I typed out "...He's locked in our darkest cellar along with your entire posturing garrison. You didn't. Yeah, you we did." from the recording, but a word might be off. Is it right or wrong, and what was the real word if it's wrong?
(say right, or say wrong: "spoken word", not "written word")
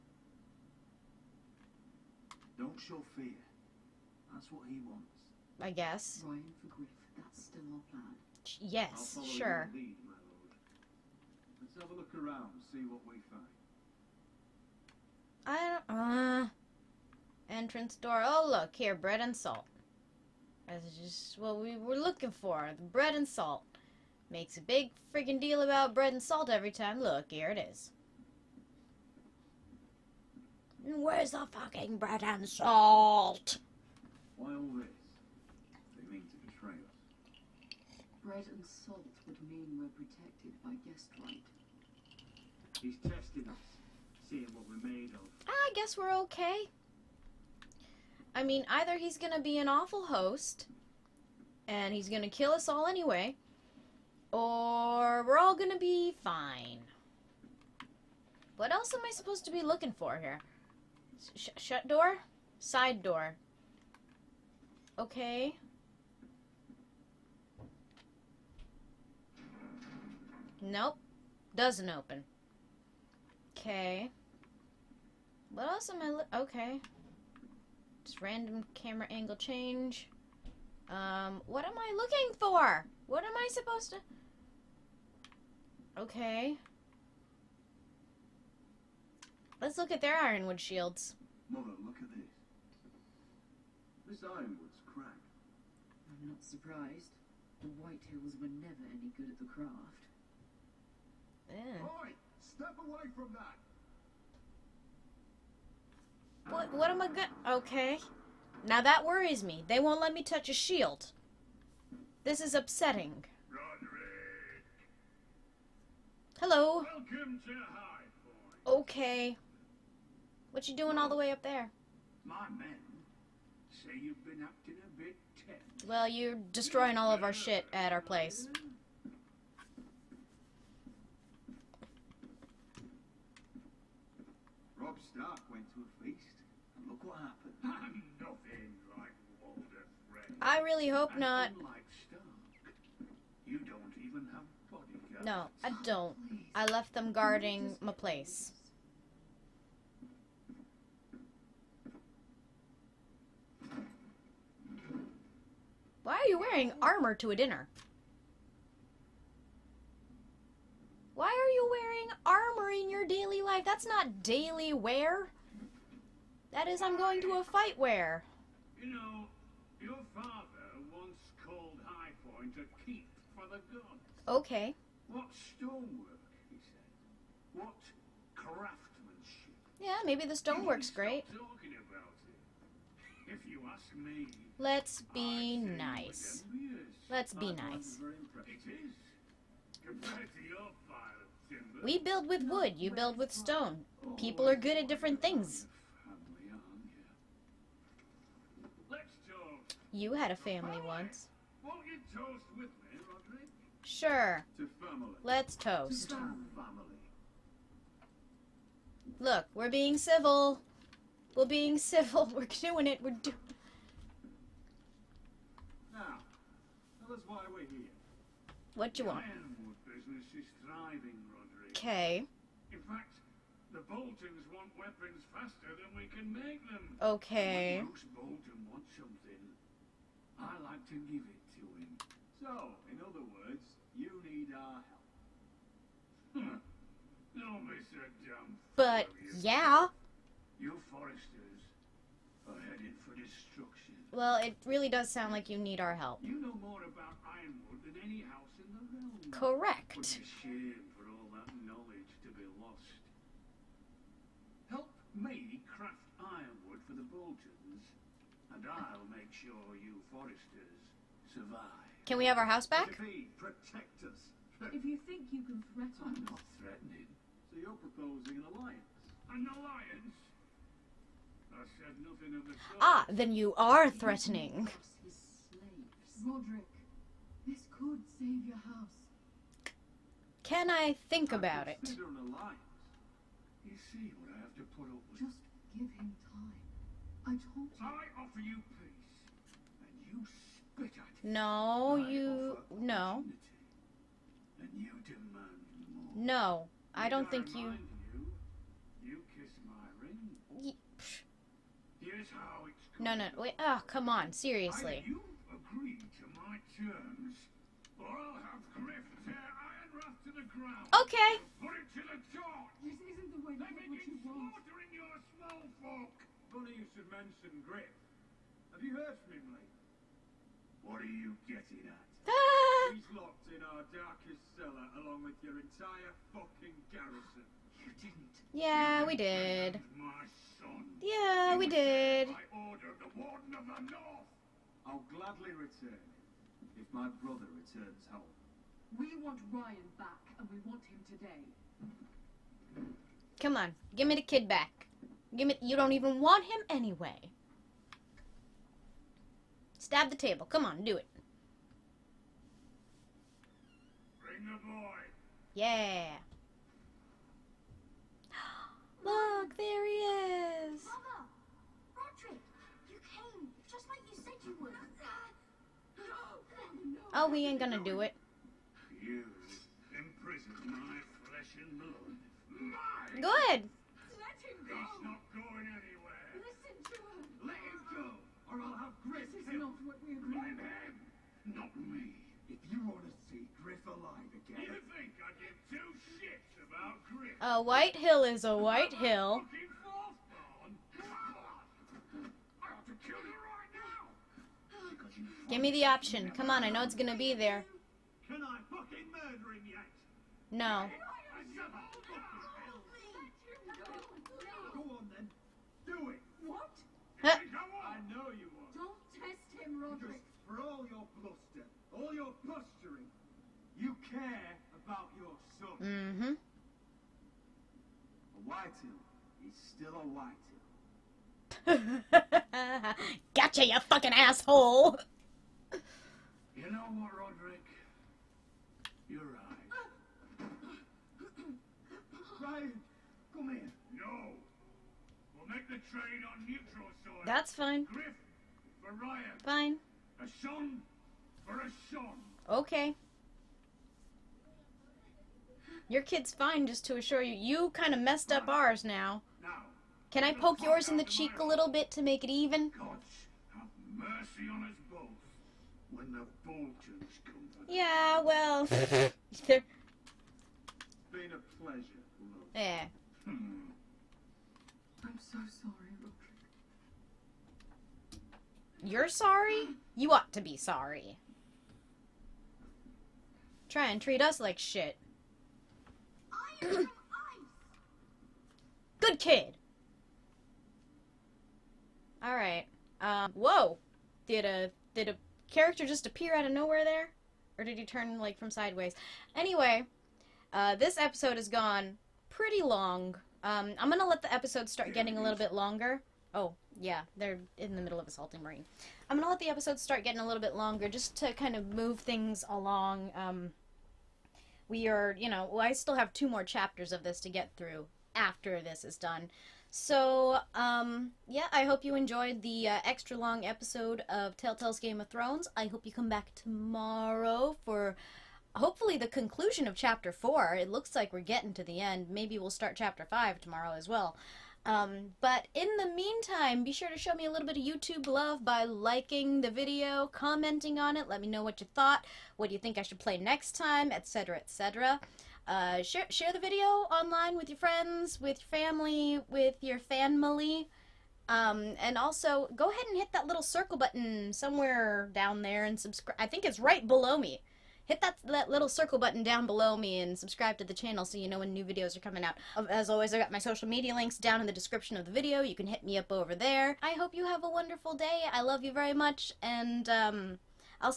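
wrong: "fucking", not "posturing".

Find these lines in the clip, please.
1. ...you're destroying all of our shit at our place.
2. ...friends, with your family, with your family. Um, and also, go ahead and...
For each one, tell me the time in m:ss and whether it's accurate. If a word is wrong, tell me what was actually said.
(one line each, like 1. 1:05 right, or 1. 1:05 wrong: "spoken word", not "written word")
1. 2:06 right
2. 8:57 right.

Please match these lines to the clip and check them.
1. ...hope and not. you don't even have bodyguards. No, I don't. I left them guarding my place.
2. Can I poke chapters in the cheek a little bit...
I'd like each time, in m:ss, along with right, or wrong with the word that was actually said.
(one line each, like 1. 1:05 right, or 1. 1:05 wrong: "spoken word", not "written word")
1. 2:20 right
2. 7:30 wrong: "yours", not "chapters".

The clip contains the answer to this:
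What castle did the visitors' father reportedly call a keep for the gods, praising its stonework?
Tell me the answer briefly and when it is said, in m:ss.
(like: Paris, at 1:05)
High Point, at 2:51.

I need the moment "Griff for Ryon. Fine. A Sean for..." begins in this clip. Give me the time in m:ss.
7:17.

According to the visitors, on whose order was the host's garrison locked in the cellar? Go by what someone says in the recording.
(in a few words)
Warden of the North.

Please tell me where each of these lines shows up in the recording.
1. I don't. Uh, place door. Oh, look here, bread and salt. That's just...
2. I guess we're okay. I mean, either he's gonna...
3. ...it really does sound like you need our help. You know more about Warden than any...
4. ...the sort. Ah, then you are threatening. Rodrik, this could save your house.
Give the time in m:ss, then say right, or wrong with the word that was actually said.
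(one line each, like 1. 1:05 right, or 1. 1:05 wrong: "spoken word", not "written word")
1. 0:15 wrong: "entrance", not "place"
2. 0:45 right
3. 4:04 wrong: "Ironwood", not "Warden"
4. 4:32 right.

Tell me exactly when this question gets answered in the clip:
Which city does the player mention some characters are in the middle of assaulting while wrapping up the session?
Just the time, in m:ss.
8:18.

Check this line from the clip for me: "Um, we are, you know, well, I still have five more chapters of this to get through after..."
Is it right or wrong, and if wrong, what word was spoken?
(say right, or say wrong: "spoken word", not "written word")
wrong: "two", not "five".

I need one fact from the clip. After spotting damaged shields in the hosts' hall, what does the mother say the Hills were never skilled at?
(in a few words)
The craft.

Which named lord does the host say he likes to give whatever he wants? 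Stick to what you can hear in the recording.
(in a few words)
Roose Bolton.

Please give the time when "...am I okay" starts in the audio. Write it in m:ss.
1:15.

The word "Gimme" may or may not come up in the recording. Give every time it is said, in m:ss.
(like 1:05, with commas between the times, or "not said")
5:45.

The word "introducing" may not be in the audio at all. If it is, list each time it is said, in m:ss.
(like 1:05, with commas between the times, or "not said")
not said.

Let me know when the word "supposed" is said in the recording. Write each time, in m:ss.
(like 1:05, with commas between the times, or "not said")
0:59, 1:23.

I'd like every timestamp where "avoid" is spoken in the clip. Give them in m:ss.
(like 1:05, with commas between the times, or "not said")
not said.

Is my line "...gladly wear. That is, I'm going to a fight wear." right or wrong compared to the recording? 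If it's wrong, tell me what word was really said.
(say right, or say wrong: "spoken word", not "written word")
wrong: "daily", not "gladly".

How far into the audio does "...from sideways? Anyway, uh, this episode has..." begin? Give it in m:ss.
8:08.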